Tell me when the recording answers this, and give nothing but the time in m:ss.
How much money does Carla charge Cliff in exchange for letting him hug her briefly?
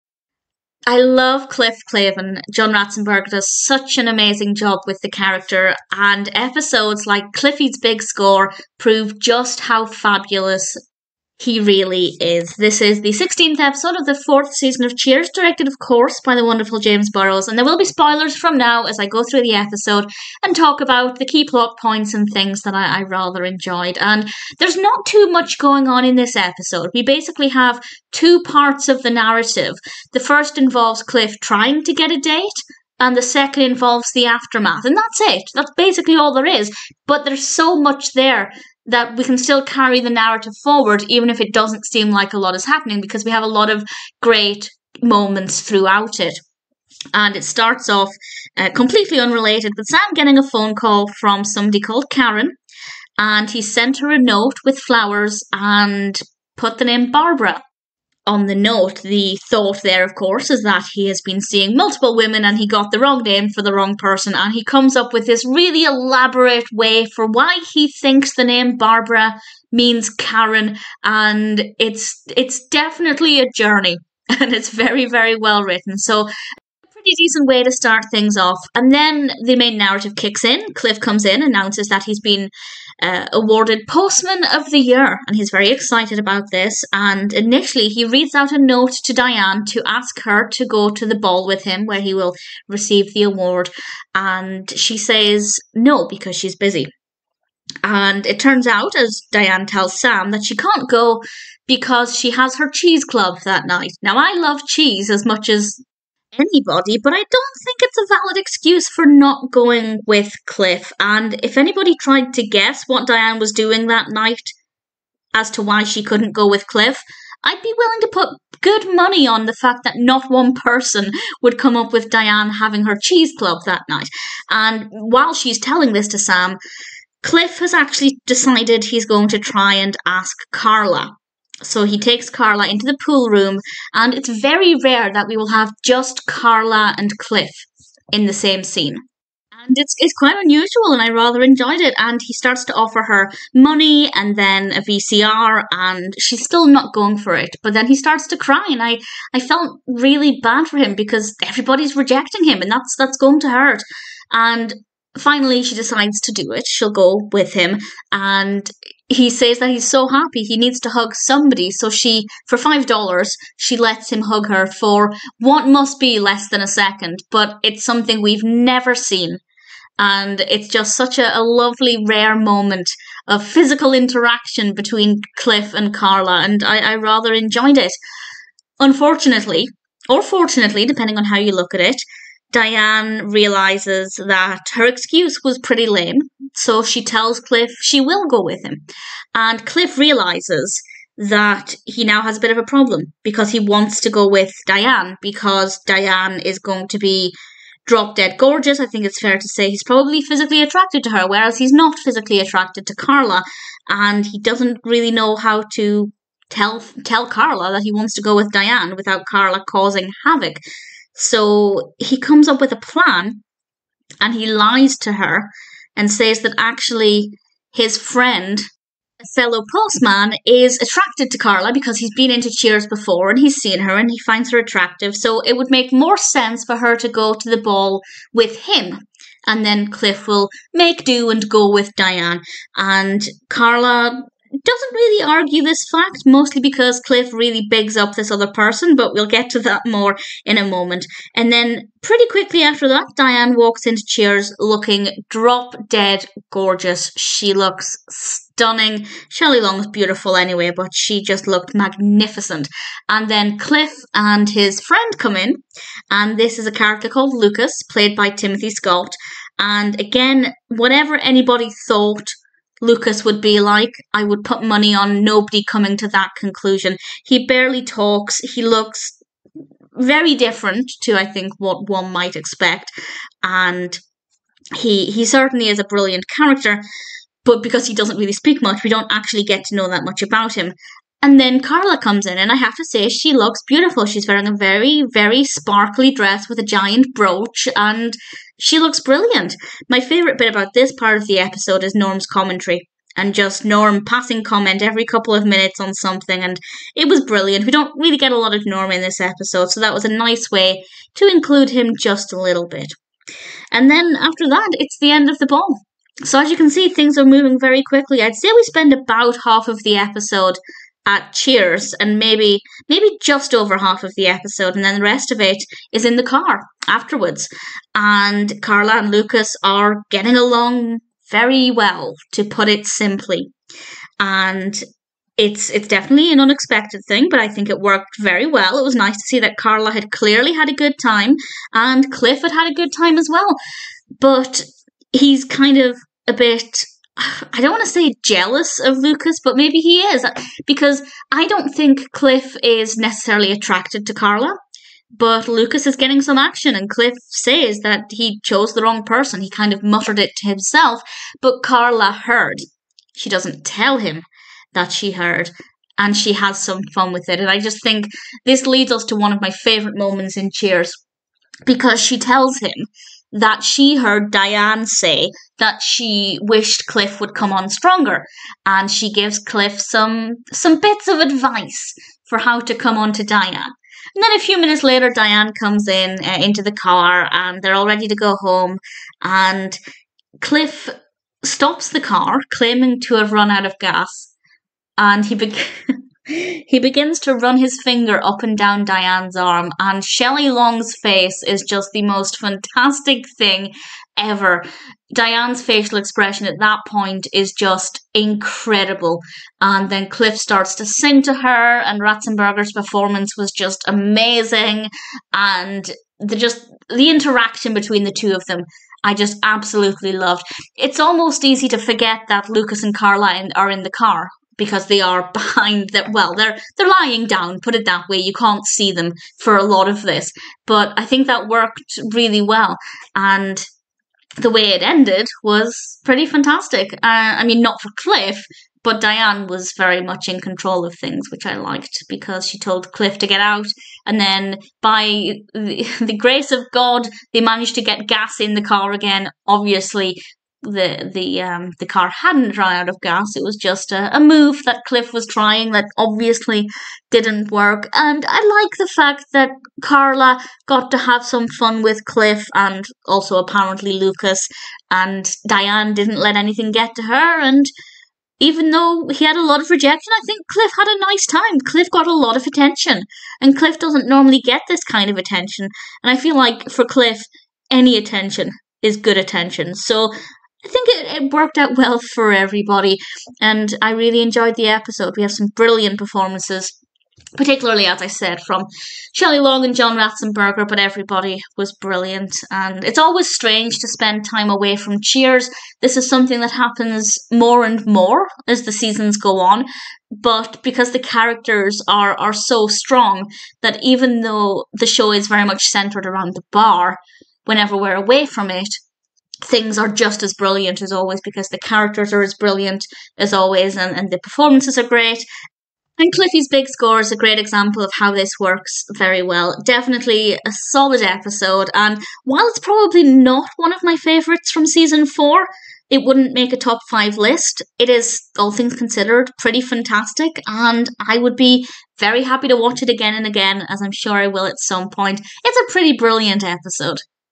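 2:42.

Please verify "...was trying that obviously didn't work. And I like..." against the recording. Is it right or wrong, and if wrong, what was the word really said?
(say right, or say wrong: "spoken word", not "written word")
right.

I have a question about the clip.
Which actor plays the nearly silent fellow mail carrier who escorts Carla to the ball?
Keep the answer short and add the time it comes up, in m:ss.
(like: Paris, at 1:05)
Timothy Scott, at 4:18.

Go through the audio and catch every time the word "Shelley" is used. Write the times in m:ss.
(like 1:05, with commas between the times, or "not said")
4:09, 6:30, 7:59.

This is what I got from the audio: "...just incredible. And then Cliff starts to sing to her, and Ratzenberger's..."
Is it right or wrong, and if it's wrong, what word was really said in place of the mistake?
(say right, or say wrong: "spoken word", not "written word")
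right.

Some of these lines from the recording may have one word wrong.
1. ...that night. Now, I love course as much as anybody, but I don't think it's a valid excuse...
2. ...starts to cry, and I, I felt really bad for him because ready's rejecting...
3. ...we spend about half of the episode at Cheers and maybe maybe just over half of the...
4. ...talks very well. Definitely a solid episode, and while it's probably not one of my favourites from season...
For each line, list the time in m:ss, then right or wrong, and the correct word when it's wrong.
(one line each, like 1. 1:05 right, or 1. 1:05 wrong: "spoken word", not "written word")
1. 1:43 wrong: "cheese", not "course"
2. 2:27 wrong: "everybody", not "ready"
3. 5:08 right
4. 8:28 wrong: "works", not "talks".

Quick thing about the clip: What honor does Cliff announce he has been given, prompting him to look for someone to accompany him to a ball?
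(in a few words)
Postman of the Year.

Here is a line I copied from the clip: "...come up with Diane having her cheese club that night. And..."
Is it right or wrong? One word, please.
right.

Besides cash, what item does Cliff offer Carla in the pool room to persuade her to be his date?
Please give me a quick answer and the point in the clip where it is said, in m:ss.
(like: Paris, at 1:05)
A VCR, at 2:24.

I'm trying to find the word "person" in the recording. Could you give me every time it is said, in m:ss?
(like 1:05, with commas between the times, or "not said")
1:03, 2:00, 3:58, 5:49.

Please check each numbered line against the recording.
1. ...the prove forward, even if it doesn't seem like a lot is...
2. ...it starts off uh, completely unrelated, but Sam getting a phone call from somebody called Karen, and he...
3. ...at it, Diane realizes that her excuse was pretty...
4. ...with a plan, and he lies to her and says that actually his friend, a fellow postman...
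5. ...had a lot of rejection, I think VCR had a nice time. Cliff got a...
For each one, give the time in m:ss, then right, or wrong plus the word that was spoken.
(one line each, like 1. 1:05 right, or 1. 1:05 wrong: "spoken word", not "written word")
1. 0:39 wrong: "narrative", not "prove"
2. 0:47 right
3. 3:01 right
4. 3:32 right
5. 7:39 wrong: "Cliff", not "VCR".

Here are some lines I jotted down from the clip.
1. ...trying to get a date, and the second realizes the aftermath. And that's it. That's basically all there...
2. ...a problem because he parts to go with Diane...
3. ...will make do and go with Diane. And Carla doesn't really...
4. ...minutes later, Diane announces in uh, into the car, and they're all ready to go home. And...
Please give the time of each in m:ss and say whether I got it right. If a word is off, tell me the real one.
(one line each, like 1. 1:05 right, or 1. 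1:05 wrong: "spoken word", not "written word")
1. 0:31 wrong: "involves", not "realizes"
2. 3:12 wrong: "wants", not "parts"
3. 3:50 right
4. 6:14 wrong: "comes", not "announces".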